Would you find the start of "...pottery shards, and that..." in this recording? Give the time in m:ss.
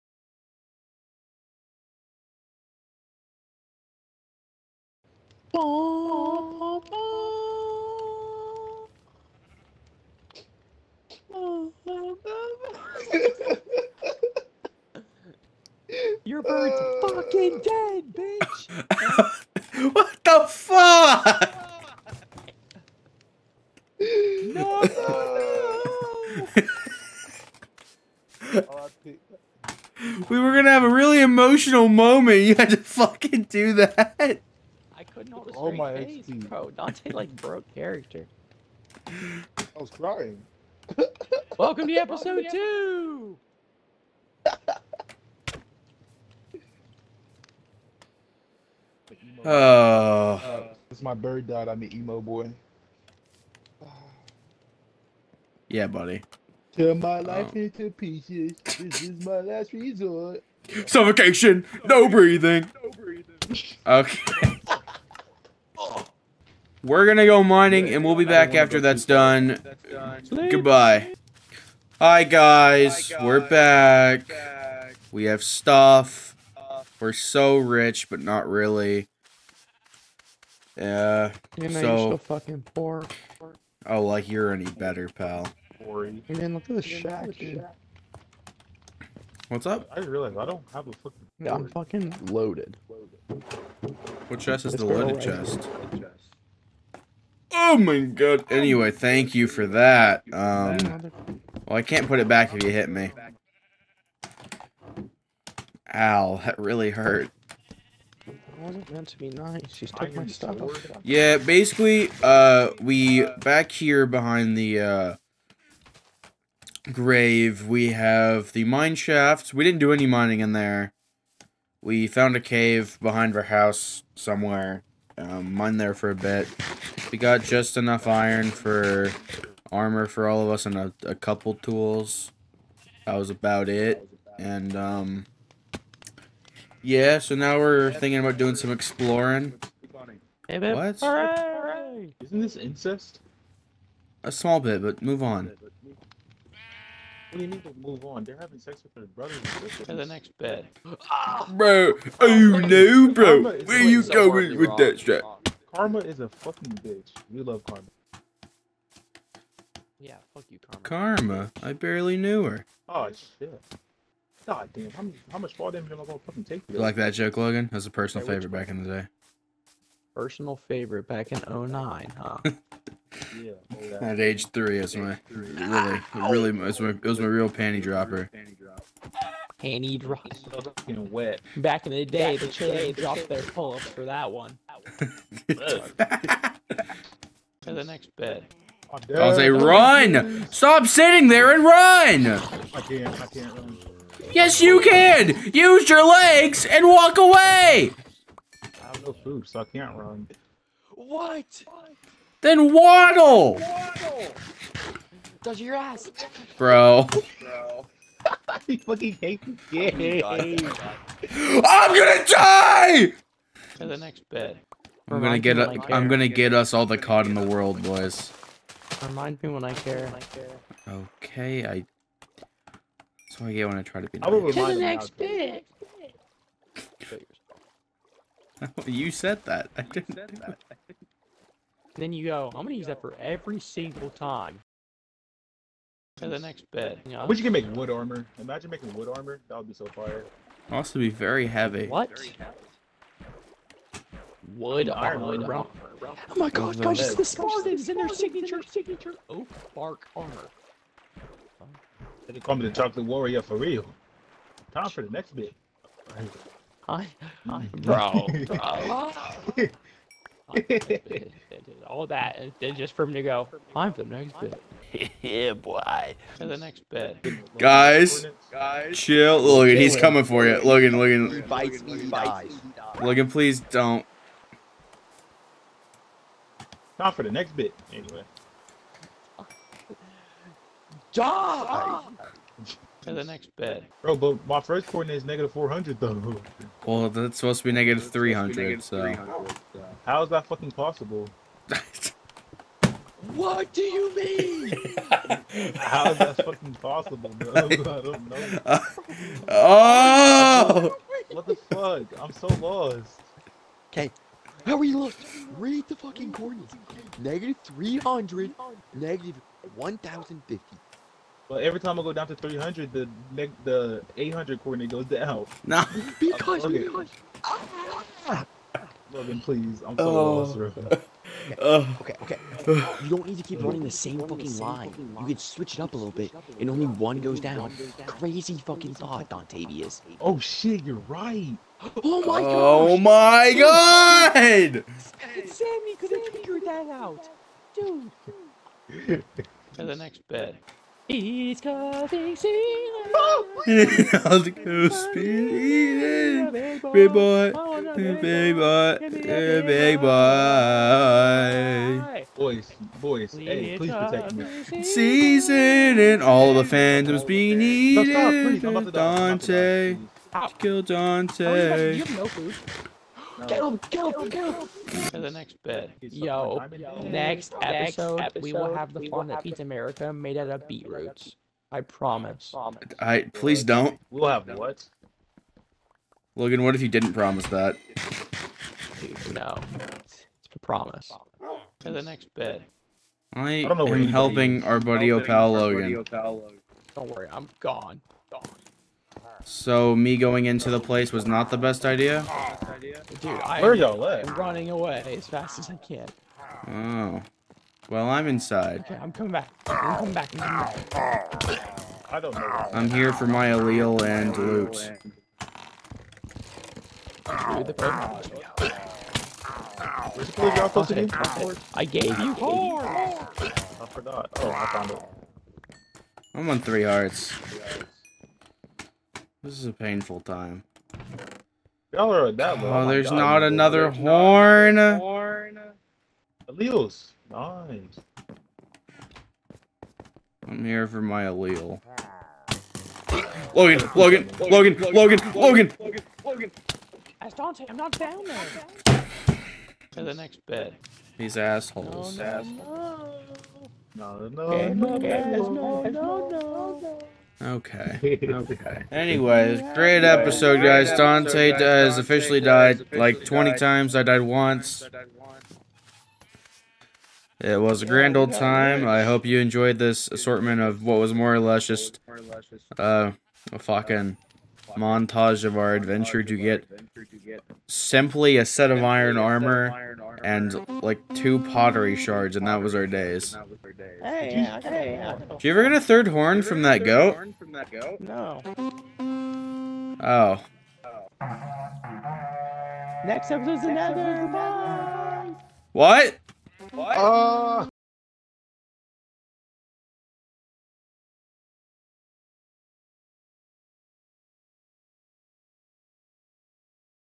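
7:51.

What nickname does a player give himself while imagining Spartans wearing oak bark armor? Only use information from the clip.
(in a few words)
the chocolate warrior.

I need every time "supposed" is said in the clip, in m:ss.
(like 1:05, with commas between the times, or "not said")
4:47.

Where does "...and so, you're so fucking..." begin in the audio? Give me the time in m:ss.
1:21.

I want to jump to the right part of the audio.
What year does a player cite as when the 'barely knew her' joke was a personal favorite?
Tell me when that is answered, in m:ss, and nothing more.
2:51.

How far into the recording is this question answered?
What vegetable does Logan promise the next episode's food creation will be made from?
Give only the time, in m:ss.
6:10.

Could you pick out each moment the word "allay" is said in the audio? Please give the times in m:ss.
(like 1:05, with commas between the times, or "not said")
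6:43, 7:06, 7:11.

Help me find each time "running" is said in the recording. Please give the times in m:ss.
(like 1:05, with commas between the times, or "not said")
5:23, 6:34.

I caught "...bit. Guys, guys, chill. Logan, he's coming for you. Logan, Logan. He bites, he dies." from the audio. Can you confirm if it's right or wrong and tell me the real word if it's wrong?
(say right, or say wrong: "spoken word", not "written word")
right.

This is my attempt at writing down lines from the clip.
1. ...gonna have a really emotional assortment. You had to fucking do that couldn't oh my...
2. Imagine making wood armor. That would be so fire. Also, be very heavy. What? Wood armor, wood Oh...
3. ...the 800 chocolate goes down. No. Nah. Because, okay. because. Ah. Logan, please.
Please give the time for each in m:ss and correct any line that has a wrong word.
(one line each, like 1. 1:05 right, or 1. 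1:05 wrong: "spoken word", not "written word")
1. 0:30 wrong: "moment", not "assortment"
2. 3:58 right
3. 5:13 wrong: "coordinate", not "chocolate".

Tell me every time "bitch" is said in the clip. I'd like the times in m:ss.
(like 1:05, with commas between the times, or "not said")
0:18, 2:36.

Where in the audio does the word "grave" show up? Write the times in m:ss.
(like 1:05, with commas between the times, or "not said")
1:56.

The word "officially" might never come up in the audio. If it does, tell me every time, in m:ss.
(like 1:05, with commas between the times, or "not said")
7:31.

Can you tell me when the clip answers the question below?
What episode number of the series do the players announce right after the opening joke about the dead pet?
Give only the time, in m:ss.
0:41.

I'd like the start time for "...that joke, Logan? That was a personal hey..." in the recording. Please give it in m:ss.
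2:46.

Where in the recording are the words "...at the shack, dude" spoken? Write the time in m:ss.
1:26.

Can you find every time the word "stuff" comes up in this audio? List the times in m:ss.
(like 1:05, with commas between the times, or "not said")
1:15, 1:50.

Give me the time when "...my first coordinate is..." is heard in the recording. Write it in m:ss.
4:44.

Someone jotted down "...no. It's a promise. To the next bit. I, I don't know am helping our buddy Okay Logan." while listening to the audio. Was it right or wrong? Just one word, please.
wrong.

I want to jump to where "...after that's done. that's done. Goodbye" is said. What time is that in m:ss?
1:08.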